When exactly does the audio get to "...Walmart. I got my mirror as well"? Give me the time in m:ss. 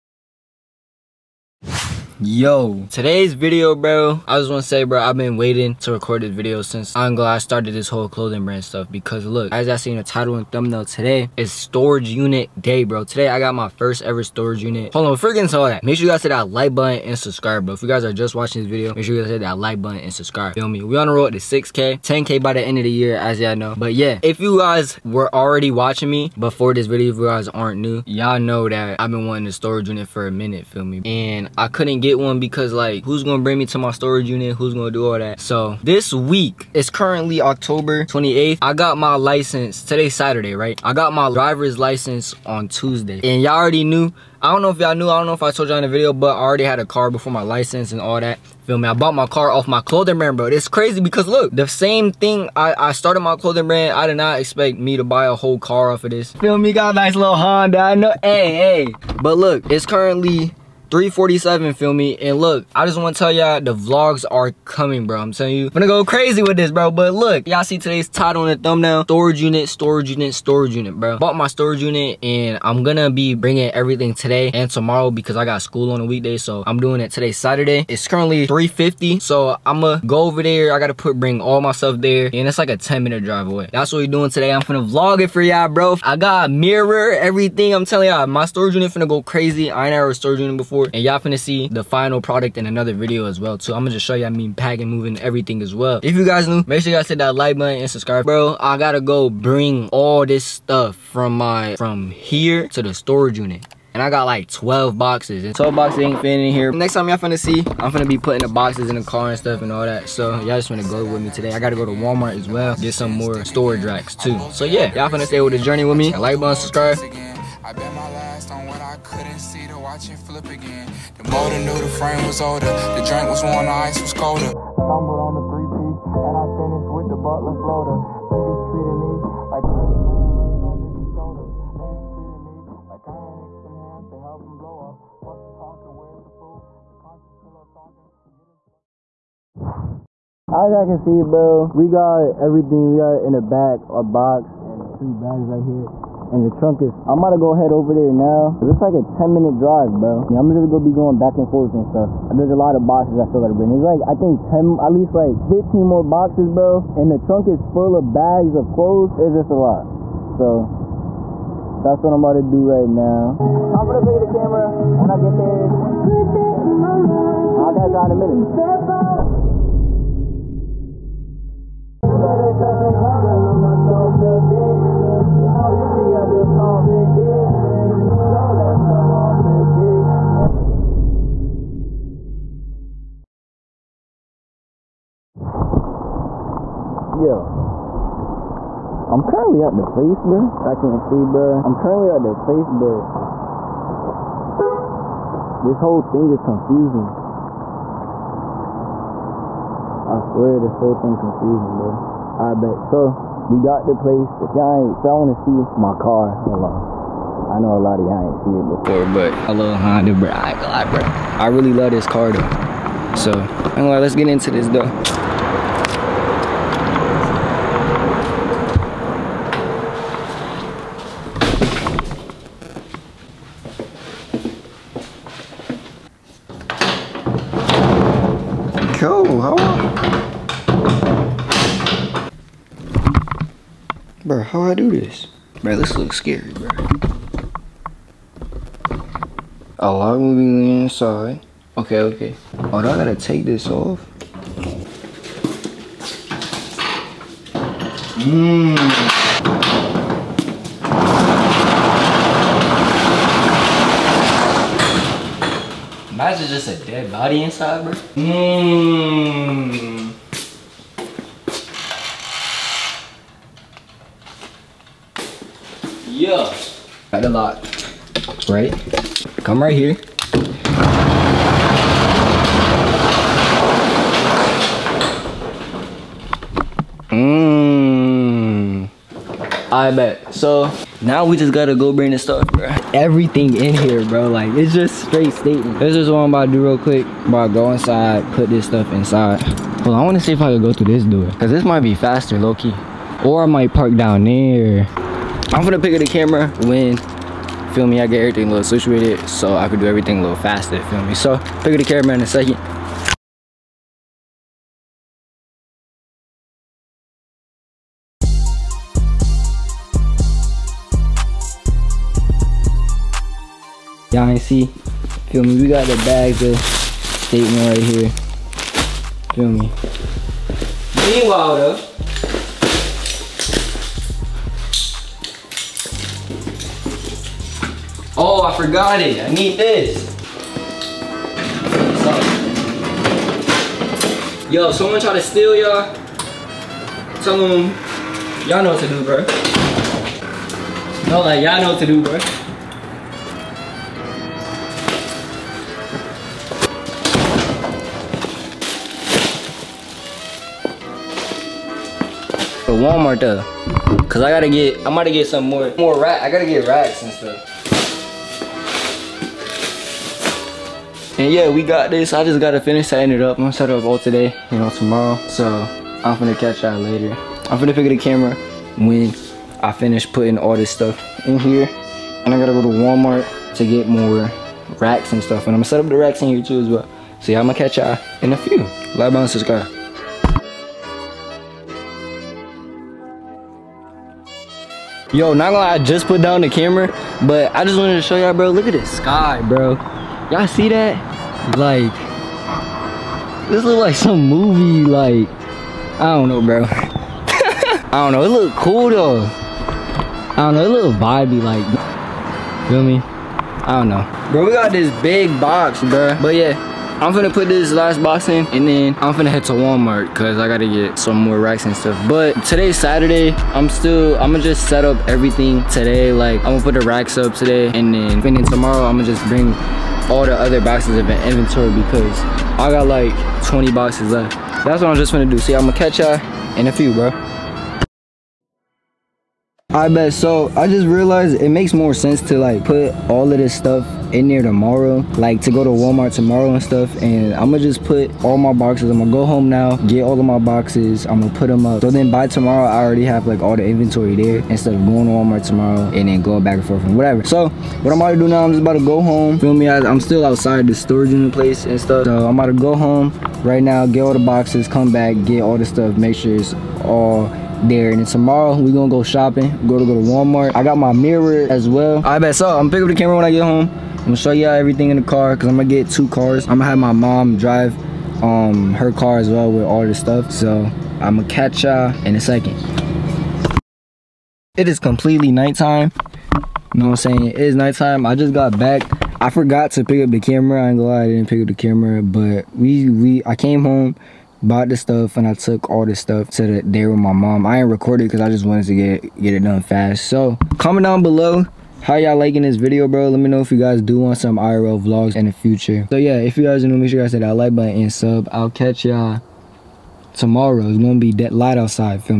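7:39.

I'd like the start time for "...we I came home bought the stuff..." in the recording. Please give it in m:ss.
8:02.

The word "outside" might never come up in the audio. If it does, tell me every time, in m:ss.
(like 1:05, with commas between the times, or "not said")
7:30, 8:21.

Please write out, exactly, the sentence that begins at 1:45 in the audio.
And 12 boxes ain't fitting in here.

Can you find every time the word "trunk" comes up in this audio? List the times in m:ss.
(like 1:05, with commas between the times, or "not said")
2:26, 2:37.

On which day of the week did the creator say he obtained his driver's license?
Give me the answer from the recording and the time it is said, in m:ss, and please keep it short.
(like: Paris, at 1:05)
Tuesday, at 0:42.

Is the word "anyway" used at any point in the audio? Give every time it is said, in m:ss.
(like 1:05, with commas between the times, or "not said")
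3:33.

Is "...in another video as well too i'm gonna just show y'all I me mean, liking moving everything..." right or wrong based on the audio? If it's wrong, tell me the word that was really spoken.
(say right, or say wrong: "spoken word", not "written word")
wrong: "packing", not "liking".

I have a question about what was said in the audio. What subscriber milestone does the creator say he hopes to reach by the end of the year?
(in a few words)
10k.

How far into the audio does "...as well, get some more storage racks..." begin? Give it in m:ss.
1:52.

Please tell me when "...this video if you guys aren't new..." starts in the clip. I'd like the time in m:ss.
0:26.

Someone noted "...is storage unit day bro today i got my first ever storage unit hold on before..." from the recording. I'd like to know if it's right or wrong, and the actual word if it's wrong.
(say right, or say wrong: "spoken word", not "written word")
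right.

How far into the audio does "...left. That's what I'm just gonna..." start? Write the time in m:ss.
7:04.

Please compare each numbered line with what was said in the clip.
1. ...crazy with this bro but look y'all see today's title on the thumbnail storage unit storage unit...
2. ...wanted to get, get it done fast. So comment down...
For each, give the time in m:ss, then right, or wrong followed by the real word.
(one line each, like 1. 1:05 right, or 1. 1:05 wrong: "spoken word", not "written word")
1. 1:06 right
2. 8:08 right.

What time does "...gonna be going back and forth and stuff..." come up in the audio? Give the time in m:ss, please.
2:30.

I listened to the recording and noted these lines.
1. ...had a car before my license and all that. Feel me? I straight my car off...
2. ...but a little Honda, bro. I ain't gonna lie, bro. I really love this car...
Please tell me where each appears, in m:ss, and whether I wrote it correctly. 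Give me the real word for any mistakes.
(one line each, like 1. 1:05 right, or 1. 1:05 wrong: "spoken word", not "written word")
1. 0:46 wrong: "bought", not "straight"
2. 3:29 right.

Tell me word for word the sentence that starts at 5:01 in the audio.
So, pick up the camera in a second.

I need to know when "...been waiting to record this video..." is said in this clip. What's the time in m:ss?
0:05.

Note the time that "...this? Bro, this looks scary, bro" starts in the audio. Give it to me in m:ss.
3:54.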